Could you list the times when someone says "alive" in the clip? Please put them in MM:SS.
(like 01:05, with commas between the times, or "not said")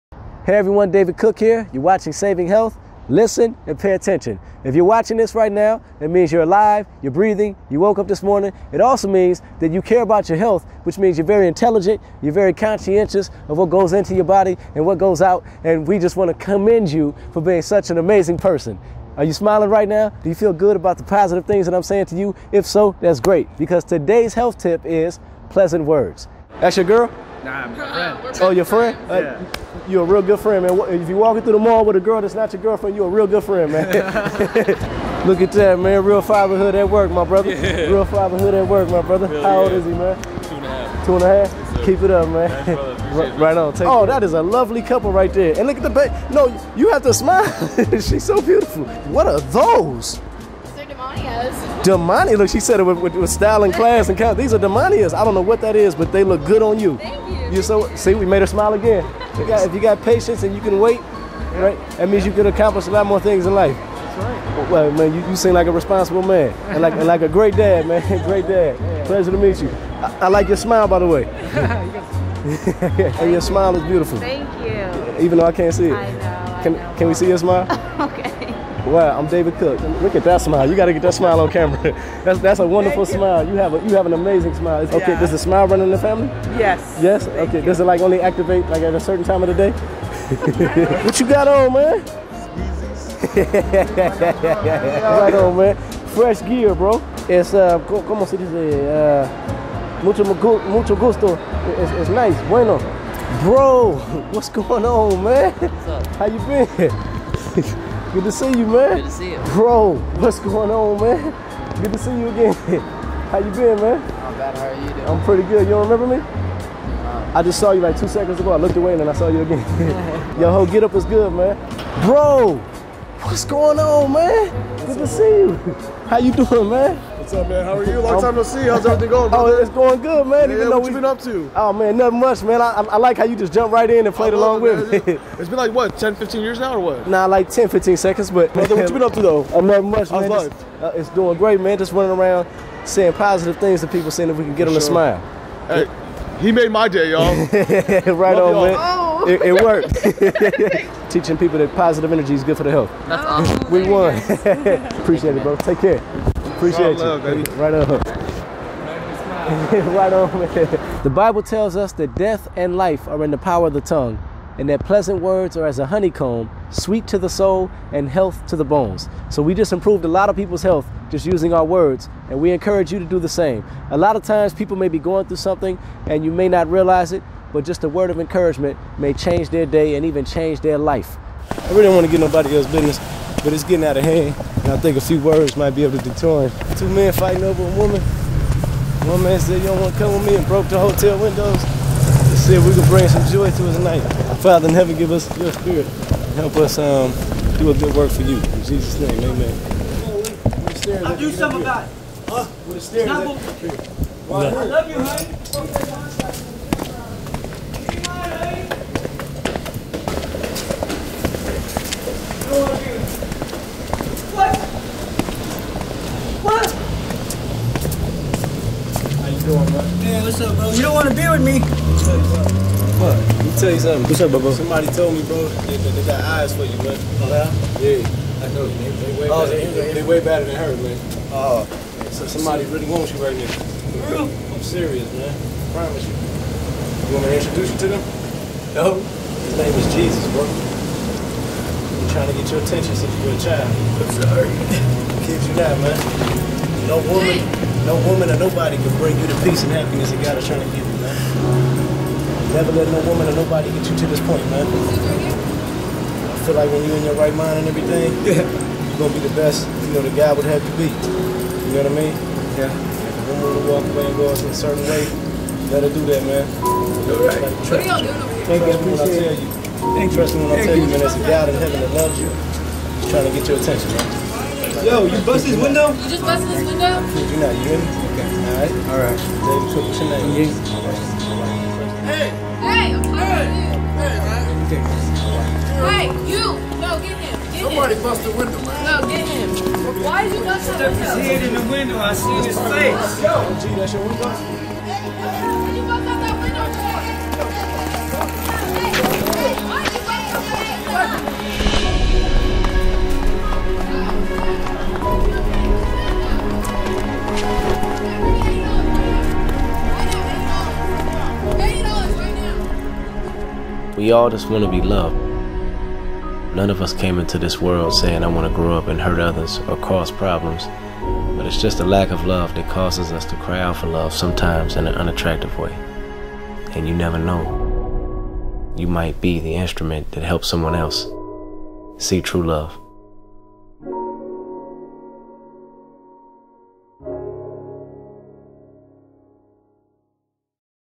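00:06.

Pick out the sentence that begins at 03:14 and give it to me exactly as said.
Father in heaven, give us your spirit.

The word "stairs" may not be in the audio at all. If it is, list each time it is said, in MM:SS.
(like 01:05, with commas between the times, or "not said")
03:22.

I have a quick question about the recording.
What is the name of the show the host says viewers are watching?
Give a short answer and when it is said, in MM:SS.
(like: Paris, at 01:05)
Saving Health, at 00:02.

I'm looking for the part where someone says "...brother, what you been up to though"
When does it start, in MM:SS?
02:18.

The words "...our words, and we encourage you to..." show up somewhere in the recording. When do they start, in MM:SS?
02:51.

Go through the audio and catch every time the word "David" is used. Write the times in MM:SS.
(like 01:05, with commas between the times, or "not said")
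00:00, 01:19.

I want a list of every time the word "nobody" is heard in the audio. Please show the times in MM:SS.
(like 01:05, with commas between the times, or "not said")
03:02, 04:08, 04:13.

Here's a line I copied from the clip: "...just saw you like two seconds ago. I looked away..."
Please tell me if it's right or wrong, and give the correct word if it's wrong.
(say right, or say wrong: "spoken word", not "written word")
right.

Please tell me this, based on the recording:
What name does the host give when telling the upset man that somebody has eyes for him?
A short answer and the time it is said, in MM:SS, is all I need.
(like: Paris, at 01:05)
Jesus, at 03:59.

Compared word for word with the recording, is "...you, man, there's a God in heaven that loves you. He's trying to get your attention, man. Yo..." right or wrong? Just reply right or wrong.
right.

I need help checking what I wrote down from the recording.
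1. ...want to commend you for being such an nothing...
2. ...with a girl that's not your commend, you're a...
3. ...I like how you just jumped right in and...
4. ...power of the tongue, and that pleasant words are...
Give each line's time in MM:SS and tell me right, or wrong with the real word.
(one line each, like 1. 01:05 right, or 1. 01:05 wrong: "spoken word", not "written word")
1. 00:16 wrong: "amazing", not "nothing"
2. 00:31 wrong: "girlfriend", not "commend"
3. 02:12 right
4. 02:43 right.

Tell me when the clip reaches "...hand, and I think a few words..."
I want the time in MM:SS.
03:04.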